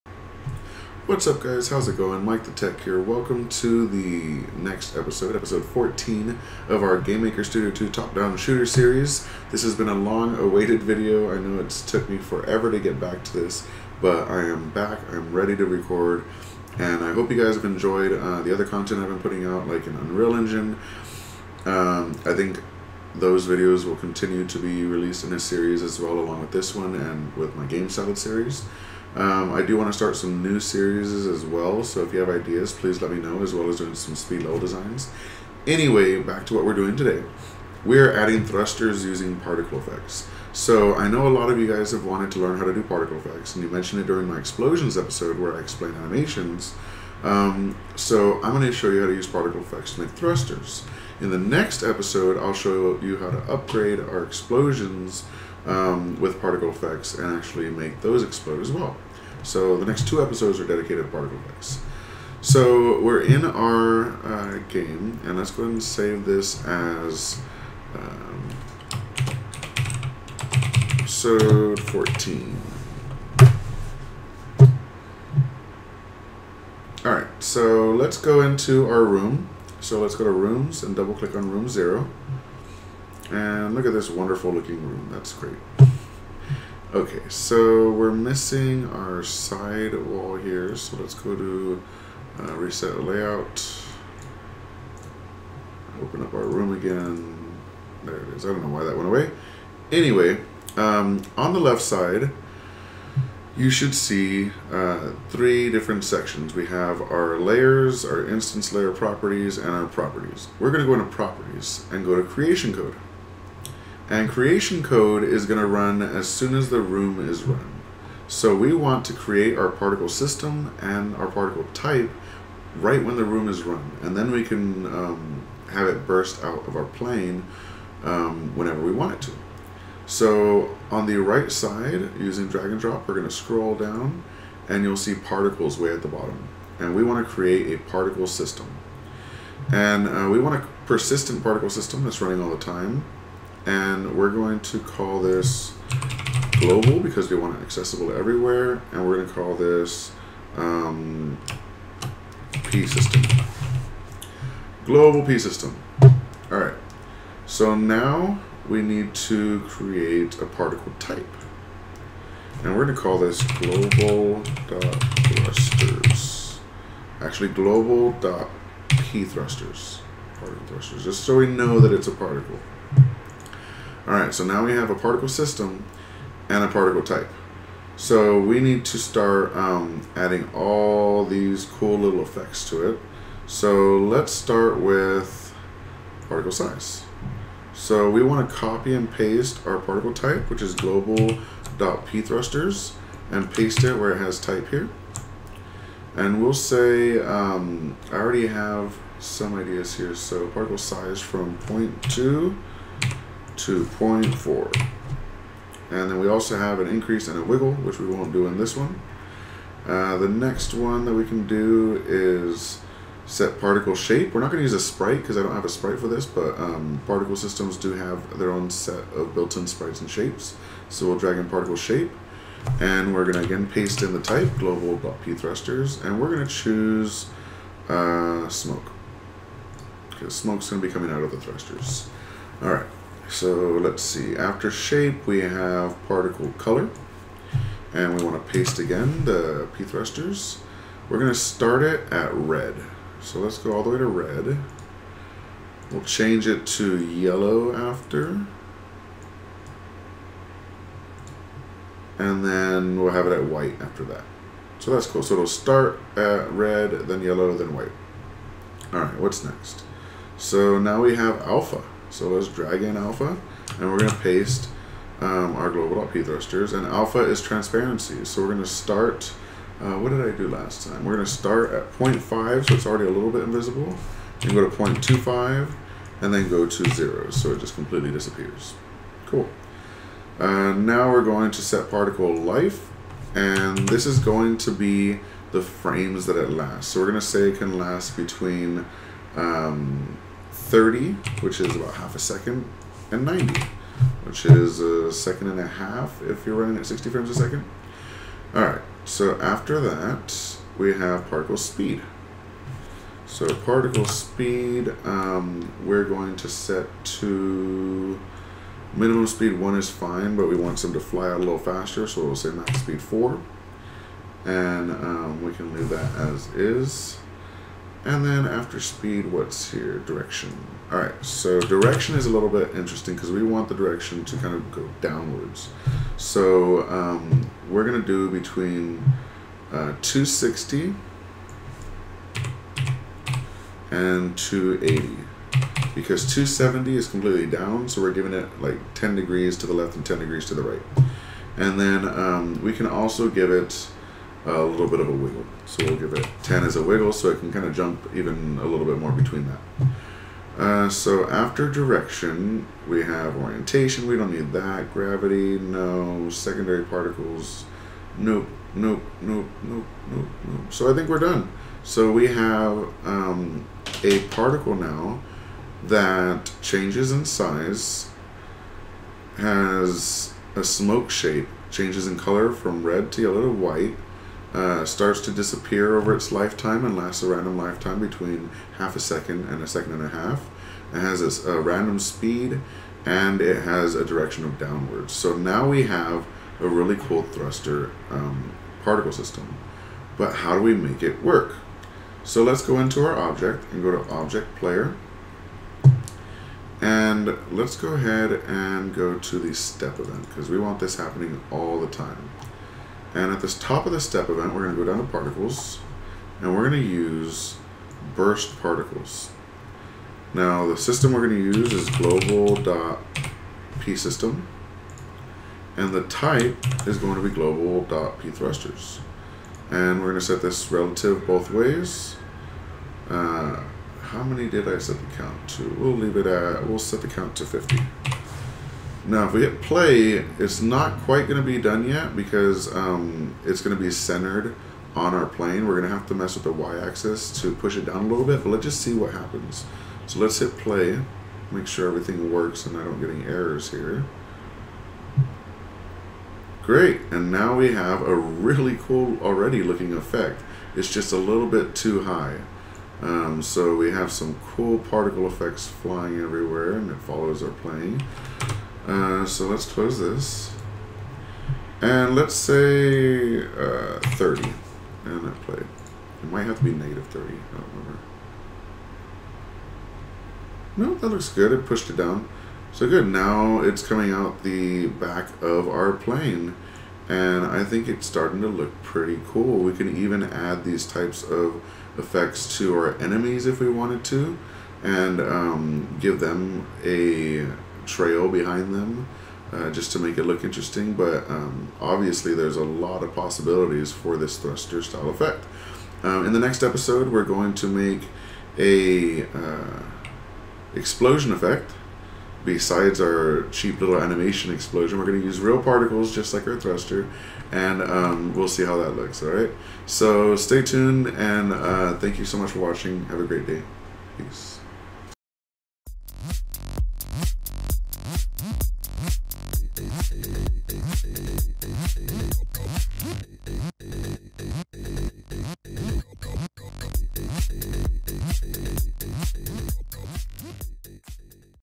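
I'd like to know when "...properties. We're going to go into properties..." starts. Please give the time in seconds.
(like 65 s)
109 s.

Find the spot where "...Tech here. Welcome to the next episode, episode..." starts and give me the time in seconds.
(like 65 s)
2 s.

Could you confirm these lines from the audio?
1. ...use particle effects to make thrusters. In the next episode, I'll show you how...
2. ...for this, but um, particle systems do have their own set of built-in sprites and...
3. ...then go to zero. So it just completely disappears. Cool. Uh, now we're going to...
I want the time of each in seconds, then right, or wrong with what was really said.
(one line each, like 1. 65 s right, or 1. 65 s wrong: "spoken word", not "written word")
1. 49 s right
2. 215 s right
3. 276 s right.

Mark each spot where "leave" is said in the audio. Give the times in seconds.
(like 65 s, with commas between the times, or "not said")
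315 s, 425 s.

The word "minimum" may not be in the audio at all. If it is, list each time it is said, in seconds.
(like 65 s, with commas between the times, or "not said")
308 s.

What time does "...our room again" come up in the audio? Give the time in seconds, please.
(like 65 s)
96 s.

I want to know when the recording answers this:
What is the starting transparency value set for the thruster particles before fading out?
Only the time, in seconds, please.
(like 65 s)
271 s.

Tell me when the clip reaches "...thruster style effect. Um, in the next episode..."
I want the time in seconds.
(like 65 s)
494 s.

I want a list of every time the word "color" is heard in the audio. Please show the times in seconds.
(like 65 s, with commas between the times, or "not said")
236 s, 372 s.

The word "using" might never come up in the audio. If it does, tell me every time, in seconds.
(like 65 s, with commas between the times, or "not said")
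39 s, 132 s.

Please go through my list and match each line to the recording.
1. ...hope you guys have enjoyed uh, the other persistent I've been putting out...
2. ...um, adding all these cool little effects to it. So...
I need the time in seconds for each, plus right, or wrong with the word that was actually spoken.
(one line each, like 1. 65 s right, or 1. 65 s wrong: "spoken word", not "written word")
1. 17 s wrong: "content", not "persistent"
2. 179 s right.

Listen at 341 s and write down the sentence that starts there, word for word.
And then um, we can also give it a little bit of a wiggle.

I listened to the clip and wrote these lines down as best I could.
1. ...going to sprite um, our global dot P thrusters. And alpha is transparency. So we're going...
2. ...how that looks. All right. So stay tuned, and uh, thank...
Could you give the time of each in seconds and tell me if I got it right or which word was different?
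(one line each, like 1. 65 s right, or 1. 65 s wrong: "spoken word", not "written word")
1. 263 s wrong: "paste", not "sprite"
2. 508 s right.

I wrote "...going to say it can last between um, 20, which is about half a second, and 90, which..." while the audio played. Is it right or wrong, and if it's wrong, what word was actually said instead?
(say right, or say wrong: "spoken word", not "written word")
wrong: "30", not "20".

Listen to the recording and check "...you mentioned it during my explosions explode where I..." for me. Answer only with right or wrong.
wrong.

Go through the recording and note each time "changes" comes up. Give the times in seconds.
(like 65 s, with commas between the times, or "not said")
246 s, 366 s, 371 s.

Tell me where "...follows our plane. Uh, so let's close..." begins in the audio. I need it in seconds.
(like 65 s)
457 s.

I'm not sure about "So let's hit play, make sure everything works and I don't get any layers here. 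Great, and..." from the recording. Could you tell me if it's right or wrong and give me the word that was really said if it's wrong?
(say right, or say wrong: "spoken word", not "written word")
wrong: "errors", not "layers".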